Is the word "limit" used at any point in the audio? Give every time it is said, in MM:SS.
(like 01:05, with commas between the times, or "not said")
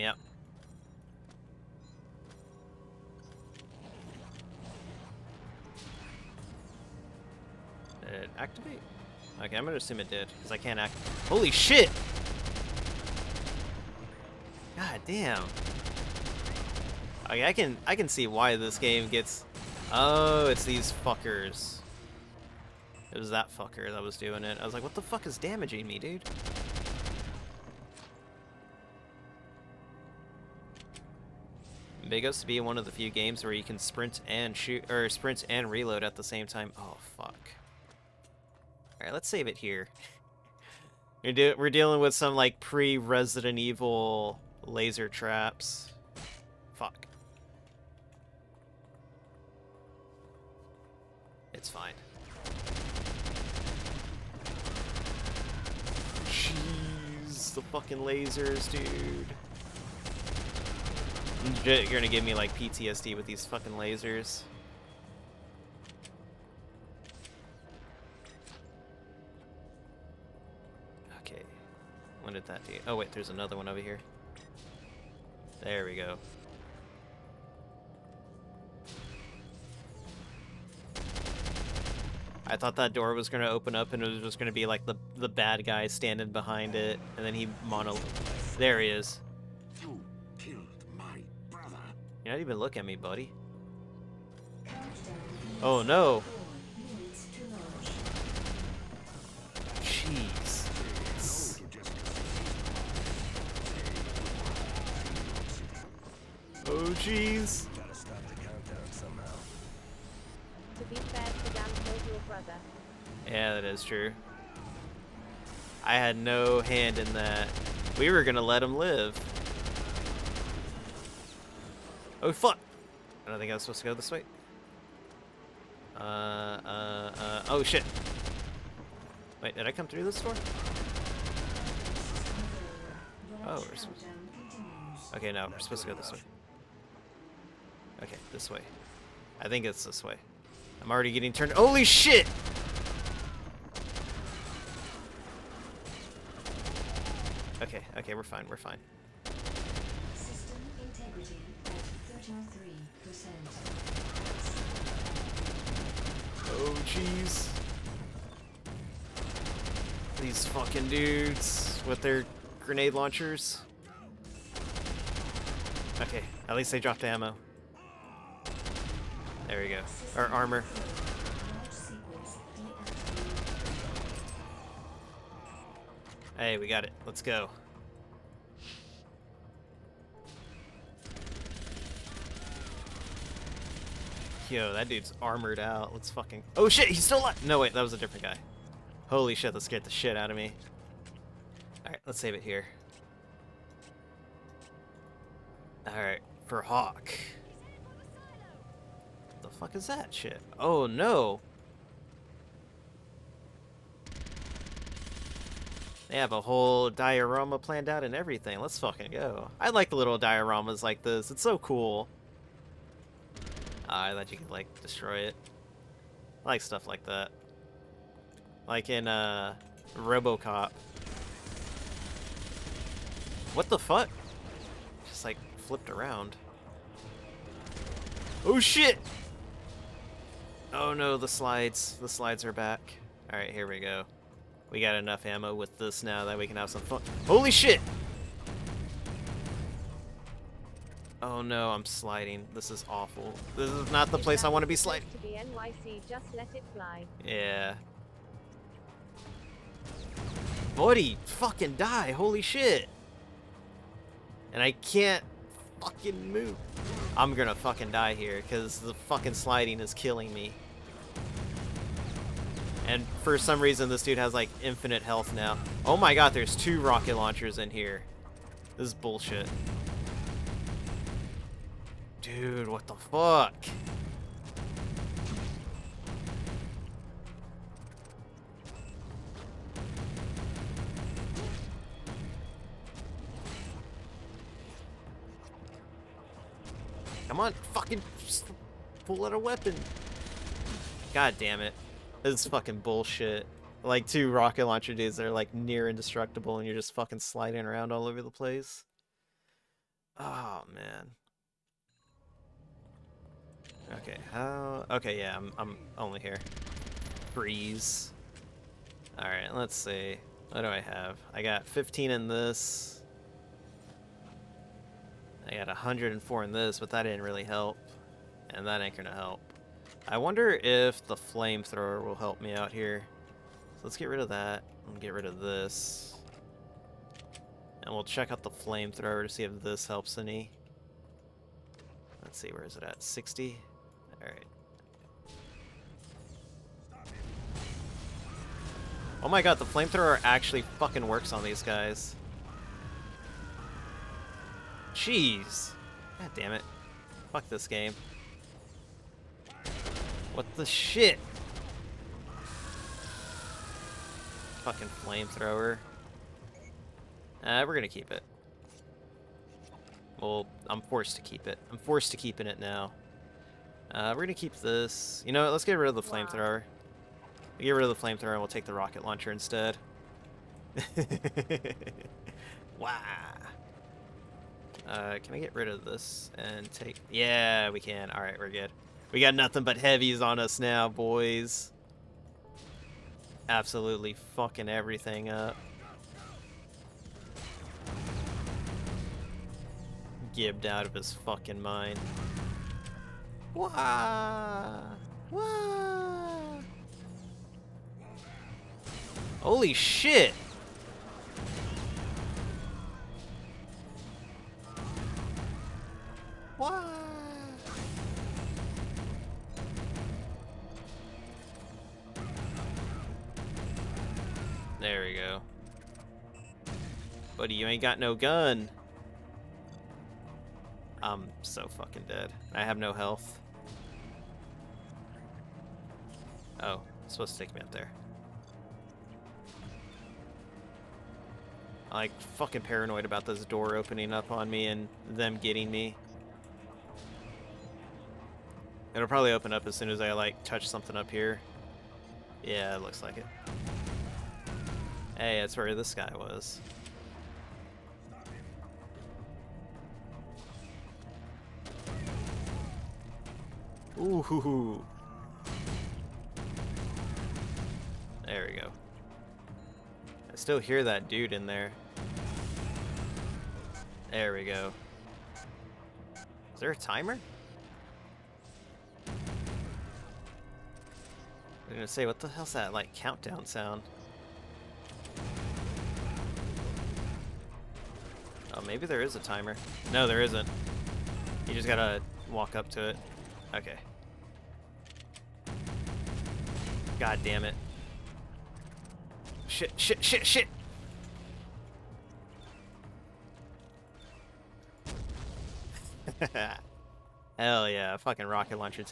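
not said.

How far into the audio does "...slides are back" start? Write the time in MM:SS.
03:52.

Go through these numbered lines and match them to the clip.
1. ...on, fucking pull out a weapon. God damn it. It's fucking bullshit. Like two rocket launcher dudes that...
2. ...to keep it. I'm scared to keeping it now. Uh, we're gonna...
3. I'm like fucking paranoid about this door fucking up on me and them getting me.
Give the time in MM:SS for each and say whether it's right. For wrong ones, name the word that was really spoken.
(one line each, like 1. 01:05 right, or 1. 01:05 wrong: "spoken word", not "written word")
1. 04:47 right
2. 06:01 wrong: "forced", not "scared"
3. 07:11 wrong: "opening", not "fucking".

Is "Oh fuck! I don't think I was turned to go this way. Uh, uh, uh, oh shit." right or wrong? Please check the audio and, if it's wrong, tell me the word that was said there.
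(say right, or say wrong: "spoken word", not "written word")
wrong: "supposed", not "turned".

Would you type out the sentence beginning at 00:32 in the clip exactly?
Big to be one of the few games where you can sprint and shoot, or sprint and reload at the same time.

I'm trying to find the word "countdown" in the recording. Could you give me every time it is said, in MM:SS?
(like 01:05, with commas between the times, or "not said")
01:48, 07:52.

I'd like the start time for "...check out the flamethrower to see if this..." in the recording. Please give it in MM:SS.
05:28.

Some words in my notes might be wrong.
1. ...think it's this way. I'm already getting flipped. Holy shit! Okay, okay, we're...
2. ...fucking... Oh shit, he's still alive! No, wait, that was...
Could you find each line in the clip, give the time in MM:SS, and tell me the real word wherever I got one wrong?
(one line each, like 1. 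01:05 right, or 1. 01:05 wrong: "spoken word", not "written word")
1. 02:19 wrong: "turned", not "flipped"
2. 03:06 right.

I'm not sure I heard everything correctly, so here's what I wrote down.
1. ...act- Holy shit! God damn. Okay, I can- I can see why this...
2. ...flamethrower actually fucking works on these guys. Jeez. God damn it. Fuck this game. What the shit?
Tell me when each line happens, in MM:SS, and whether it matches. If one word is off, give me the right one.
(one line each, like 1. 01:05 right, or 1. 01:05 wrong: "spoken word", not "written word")
1. 00:10 right
2. 05:39 right.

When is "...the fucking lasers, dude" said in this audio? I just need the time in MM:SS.
00:57.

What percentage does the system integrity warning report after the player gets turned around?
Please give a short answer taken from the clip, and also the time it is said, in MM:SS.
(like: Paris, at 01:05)
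33%, at 02:32.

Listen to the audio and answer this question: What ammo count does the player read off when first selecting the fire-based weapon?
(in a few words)
60.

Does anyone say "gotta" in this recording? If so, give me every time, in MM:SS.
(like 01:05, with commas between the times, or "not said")
01:47, 08:01.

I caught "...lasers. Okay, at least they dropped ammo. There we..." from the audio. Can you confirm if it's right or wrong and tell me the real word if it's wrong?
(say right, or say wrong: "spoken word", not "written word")
wrong: "launchers", not "lasers".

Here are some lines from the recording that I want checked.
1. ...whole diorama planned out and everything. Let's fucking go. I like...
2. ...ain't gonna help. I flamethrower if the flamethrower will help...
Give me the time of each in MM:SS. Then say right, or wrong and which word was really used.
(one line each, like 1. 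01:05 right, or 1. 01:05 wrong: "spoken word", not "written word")
1. 03:26 right
2. 05:18 wrong: "wonder", not "flamethrower".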